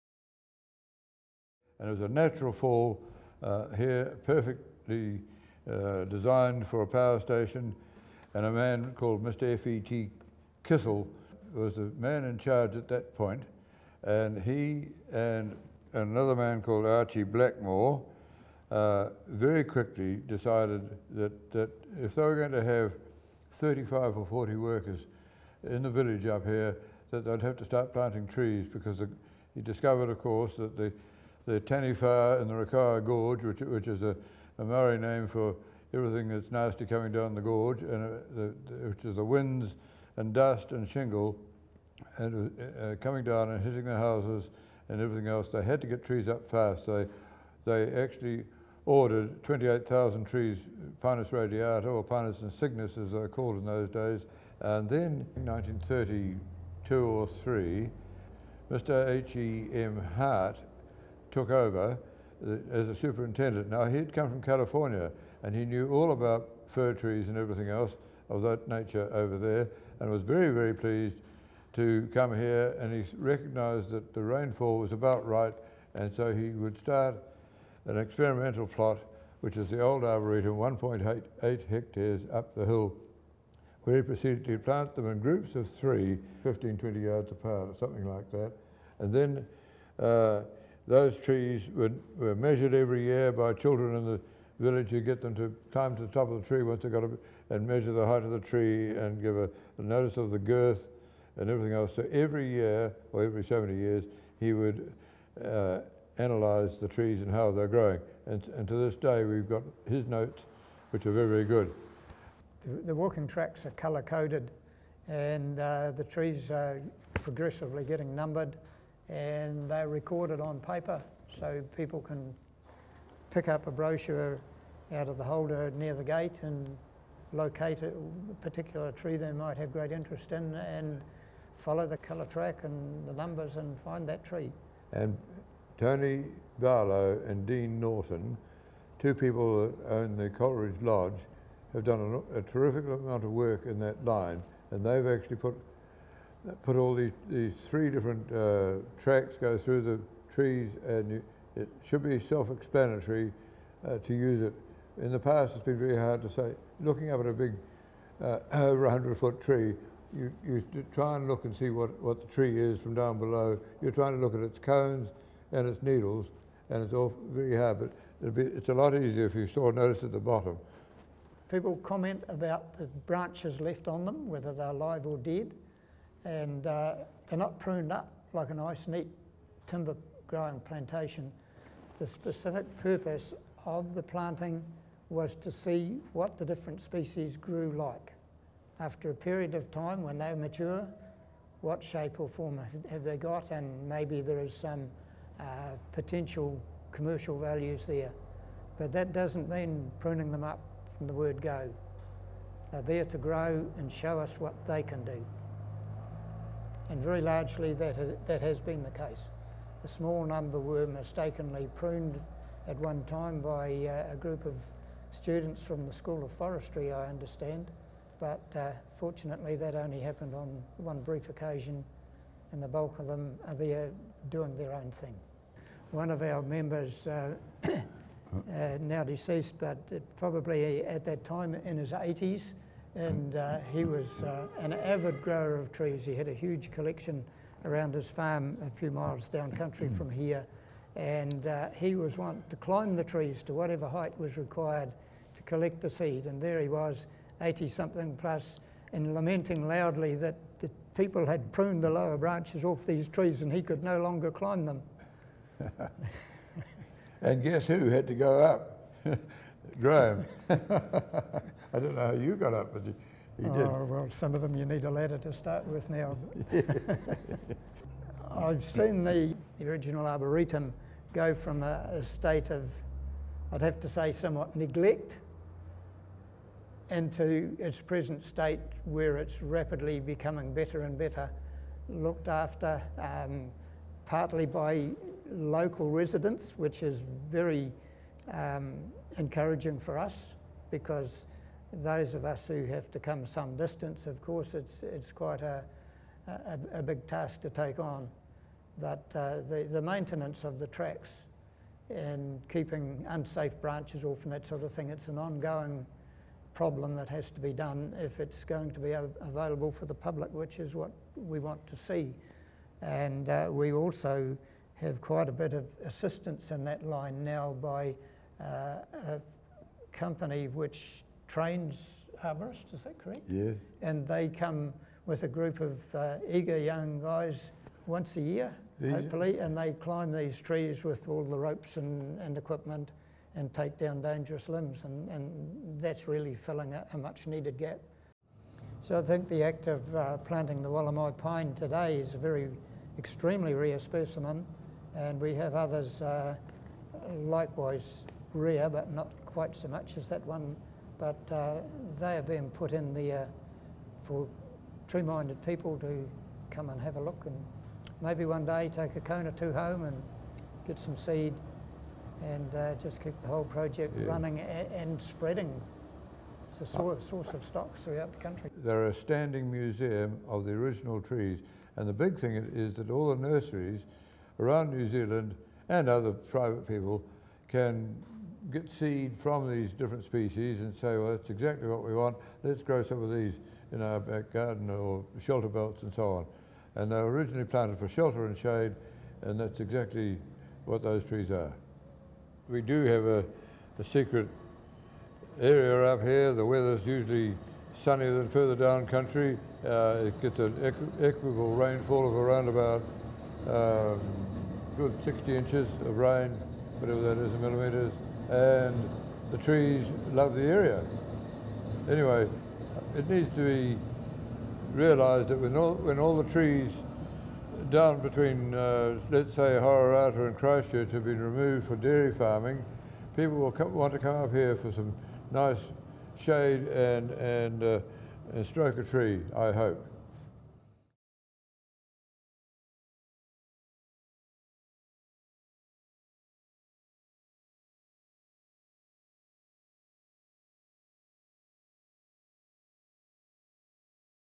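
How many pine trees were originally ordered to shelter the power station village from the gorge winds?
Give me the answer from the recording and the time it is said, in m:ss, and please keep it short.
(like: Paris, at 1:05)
28,000, at 0:49.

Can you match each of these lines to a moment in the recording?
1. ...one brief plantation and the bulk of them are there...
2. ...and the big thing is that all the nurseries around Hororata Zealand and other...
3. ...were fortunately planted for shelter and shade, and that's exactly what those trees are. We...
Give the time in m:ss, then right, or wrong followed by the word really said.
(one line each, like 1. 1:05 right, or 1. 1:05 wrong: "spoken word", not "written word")
1. 3:40 wrong: "occasion", not "plantation"
2. 6:11 wrong: "New", not "Hororata"
3. 6:26 wrong: "originally", not "fortunately".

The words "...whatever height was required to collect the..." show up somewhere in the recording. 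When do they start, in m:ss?
4:03.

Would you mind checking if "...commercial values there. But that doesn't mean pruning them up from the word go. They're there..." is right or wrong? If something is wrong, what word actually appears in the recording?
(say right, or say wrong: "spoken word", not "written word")
right.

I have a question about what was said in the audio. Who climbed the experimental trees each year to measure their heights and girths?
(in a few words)
Children in the village.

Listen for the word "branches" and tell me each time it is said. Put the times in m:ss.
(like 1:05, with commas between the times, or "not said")
2:53, 4:12, 5:03.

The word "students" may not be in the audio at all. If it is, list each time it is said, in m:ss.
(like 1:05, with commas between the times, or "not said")
3:35.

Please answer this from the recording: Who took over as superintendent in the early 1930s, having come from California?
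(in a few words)
H.E.M. Hart.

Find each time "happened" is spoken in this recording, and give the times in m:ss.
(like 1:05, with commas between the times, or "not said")
3:40.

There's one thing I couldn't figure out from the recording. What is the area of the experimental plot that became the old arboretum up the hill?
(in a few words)
1.8 hectares.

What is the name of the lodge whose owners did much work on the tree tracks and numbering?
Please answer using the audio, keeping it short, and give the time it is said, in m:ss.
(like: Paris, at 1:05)
Coleridge Lodge, at 2:20.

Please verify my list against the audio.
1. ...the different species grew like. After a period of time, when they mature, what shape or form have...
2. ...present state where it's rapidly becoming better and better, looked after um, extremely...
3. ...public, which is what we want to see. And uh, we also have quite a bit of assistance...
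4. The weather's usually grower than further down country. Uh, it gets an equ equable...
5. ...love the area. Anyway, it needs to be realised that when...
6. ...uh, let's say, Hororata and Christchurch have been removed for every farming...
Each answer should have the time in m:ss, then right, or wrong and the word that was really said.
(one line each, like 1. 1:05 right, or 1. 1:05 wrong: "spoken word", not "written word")
1. 3:06 right
2. 4:37 wrong: "partly", not "extremely"
3. 5:09 right
4. 6:36 wrong: "sunnier", not "grower"
5. 6:50 right
6. 6:58 wrong: "dairy", not "every".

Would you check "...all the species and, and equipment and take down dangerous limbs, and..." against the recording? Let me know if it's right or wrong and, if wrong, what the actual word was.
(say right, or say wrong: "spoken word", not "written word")
wrong: "ropes", not "species".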